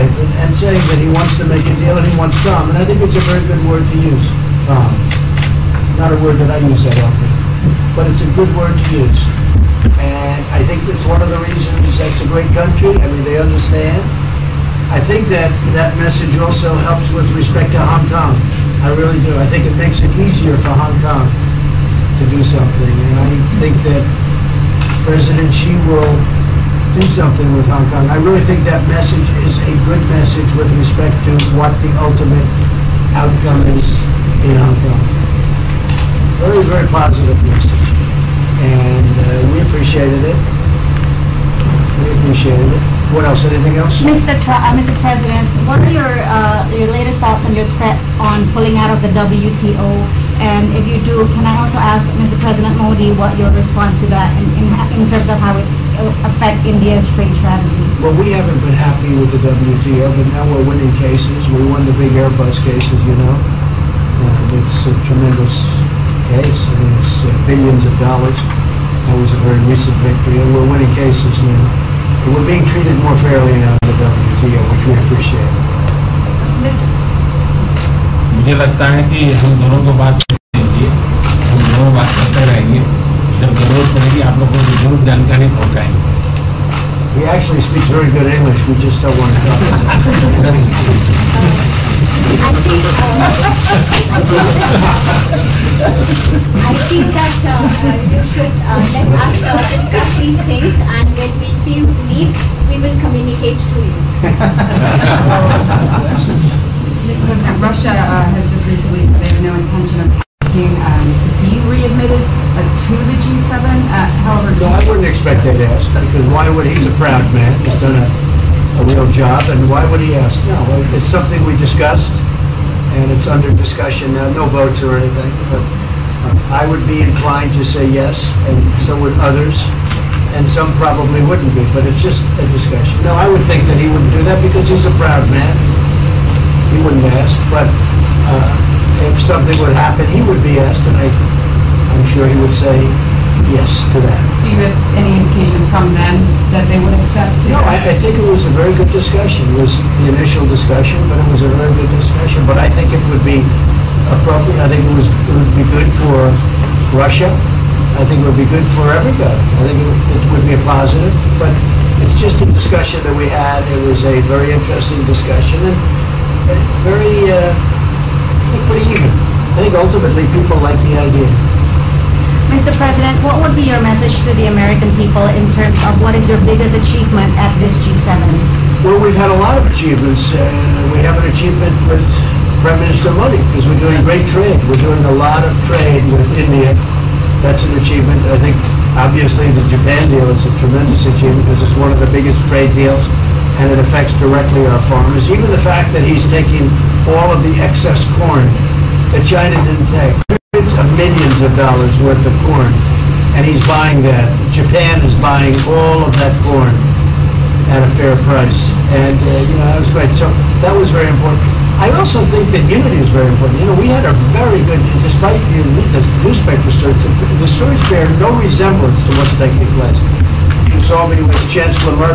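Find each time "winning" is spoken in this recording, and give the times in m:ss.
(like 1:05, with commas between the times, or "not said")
1:00, 1:10.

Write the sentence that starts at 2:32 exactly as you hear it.
But I think it would be appropriate.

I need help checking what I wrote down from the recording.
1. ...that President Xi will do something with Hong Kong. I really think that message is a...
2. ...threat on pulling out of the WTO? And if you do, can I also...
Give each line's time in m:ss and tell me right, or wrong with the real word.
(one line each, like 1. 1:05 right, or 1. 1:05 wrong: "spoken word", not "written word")
1. 0:23 right
2. 0:47 right.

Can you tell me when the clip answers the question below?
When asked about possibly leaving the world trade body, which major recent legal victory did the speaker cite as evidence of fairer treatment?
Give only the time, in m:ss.
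1:02.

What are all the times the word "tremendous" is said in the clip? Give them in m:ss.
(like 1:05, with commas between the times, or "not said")
1:05, 3:10.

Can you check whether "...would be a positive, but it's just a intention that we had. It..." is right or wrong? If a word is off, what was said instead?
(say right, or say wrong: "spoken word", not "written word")
wrong: "discussion", not "intention".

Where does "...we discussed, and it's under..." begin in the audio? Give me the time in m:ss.
2:01.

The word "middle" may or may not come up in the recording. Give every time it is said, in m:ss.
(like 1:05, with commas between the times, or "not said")
not said.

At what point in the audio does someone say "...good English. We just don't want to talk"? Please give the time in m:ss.
1:28.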